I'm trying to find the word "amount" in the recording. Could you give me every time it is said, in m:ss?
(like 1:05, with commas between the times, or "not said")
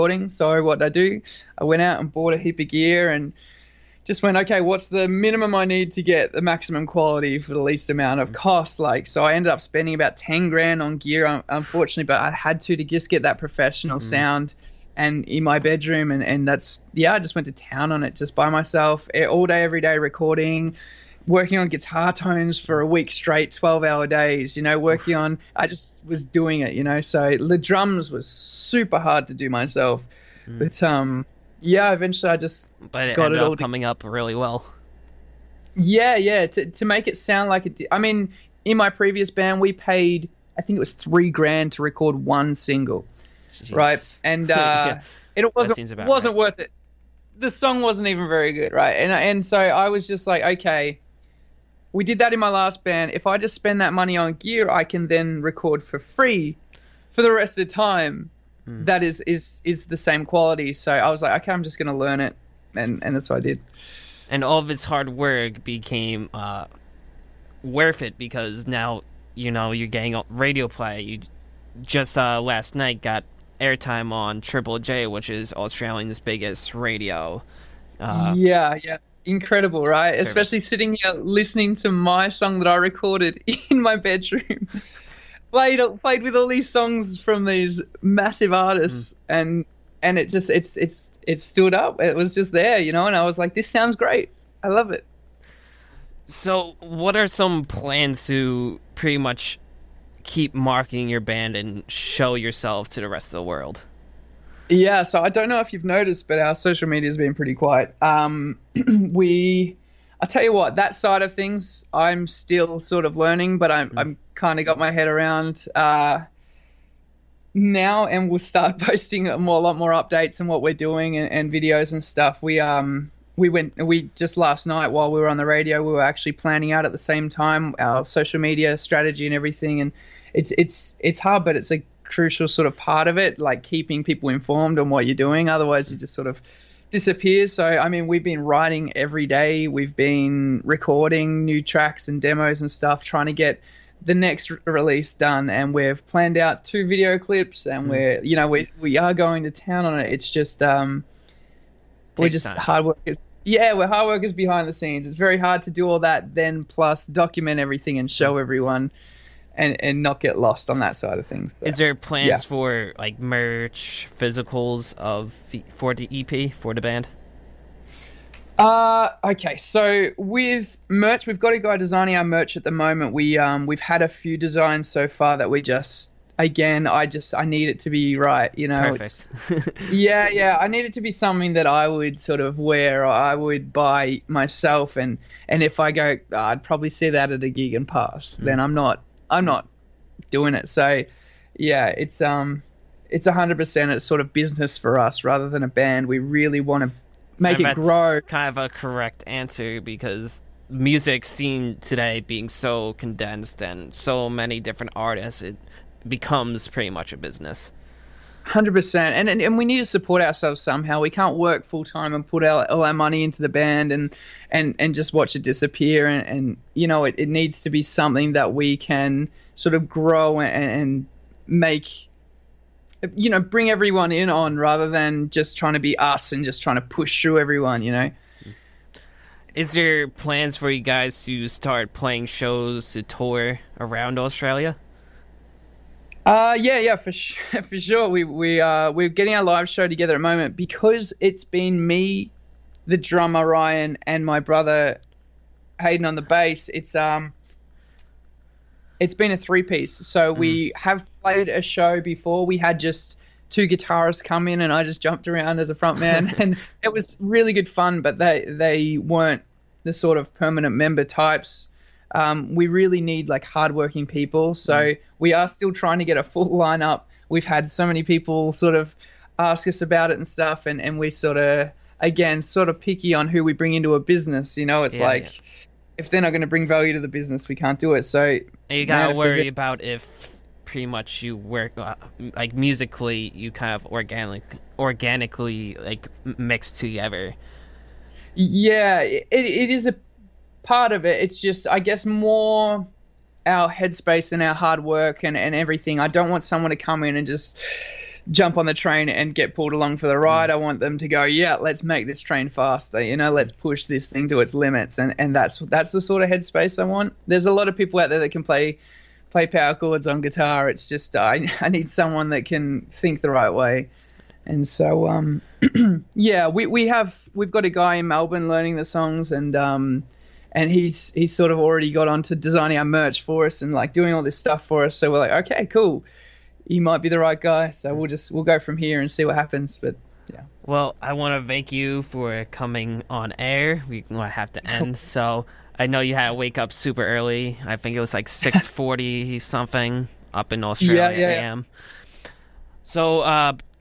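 0:07.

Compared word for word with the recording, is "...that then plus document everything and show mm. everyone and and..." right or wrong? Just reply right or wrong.
right.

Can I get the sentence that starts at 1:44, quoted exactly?
Yeah, so I don't know if you've noticed, but our social media has been pretty quiet.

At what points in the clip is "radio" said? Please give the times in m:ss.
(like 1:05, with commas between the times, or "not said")
1:10, 1:16, 2:05.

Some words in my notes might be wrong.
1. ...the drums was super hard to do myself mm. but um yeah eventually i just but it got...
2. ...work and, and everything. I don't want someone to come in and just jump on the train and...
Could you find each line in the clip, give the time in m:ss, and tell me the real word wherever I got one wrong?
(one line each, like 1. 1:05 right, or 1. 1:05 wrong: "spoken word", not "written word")
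1. 0:27 right
2. 4:54 right.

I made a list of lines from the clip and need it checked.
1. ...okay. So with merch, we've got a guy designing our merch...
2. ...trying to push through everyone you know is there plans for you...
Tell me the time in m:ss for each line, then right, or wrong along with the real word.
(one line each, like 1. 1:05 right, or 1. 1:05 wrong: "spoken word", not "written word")
1. 2:49 right
2. 3:46 right.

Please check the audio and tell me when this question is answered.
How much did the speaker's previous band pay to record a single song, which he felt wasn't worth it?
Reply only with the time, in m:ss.
0:40.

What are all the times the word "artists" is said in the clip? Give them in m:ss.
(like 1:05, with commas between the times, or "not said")
1:28, 3:24.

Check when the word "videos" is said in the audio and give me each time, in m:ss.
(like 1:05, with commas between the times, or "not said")
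2:01, 2:26.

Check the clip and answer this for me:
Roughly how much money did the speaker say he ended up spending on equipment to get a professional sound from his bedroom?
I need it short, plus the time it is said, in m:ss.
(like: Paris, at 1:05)
$10,000, at 0:10.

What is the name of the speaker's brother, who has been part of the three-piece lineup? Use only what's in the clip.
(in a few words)
Hayden.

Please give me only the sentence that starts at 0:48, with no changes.
And and so I was just like, okay, we did that in my last band.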